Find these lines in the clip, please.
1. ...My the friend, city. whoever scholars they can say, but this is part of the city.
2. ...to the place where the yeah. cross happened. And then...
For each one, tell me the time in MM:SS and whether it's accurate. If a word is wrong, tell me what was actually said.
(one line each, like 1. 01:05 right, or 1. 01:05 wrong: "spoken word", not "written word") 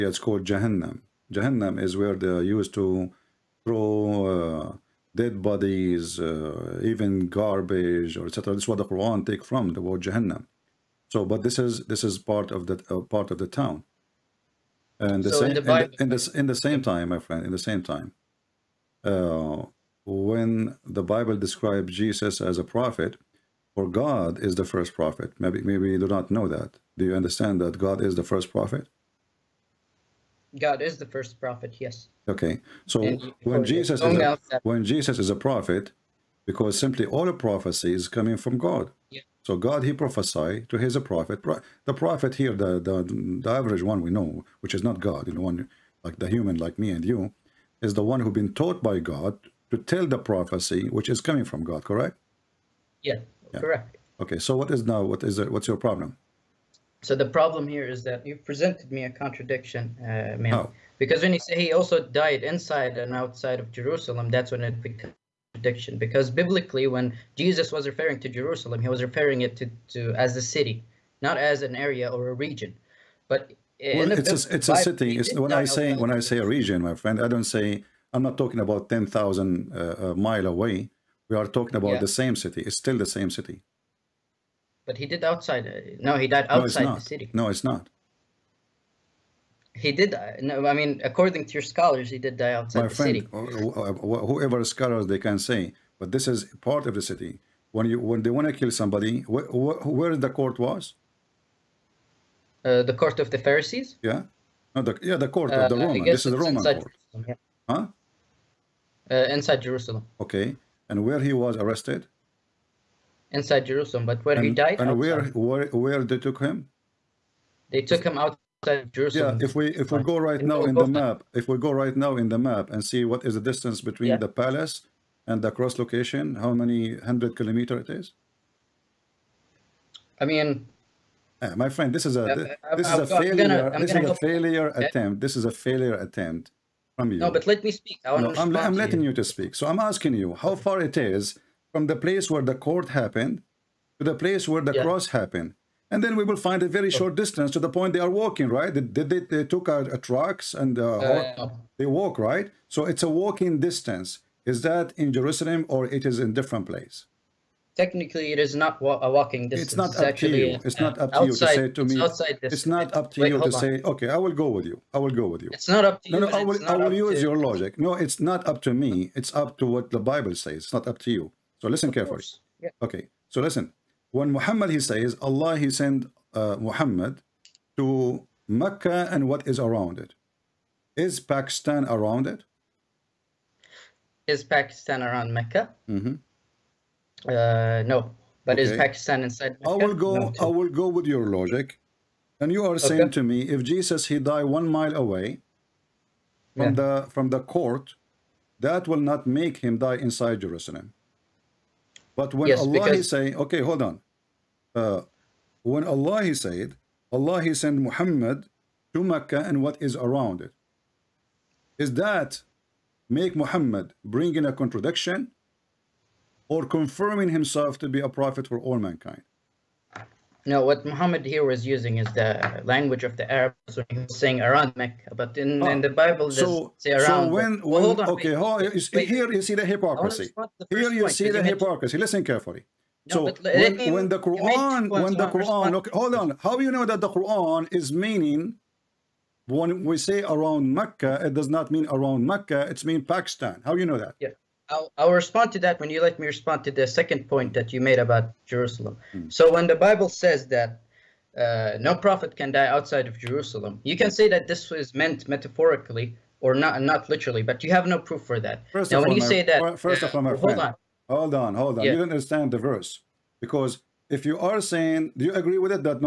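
1. 01:32 right
2. 02:23 right.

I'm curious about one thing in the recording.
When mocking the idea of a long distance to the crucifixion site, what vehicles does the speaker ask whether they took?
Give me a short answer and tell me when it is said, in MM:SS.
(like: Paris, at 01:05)
trucks, at 02:29.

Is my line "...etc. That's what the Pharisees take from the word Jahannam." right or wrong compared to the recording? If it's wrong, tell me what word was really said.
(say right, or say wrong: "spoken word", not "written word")
wrong: "Quran", not "Pharisees".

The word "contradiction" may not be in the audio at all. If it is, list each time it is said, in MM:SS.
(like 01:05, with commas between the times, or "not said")
00:59, 01:05, 03:34.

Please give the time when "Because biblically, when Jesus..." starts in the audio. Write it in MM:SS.
01:05.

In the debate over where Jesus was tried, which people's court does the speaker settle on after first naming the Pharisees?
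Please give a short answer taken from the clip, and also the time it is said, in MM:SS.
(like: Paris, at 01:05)
the Roman court, at 01:46.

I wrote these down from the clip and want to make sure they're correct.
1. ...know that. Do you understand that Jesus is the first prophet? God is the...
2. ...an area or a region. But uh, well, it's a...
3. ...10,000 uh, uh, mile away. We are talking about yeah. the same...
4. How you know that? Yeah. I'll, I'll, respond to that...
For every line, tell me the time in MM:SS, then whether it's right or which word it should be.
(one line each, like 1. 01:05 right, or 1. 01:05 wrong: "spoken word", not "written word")
1. 00:26 wrong: "God", not "Jesus"
2. 01:11 right
3. 01:18 right
4. 04:03 right.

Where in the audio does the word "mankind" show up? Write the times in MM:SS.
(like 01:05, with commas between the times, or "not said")
03:38.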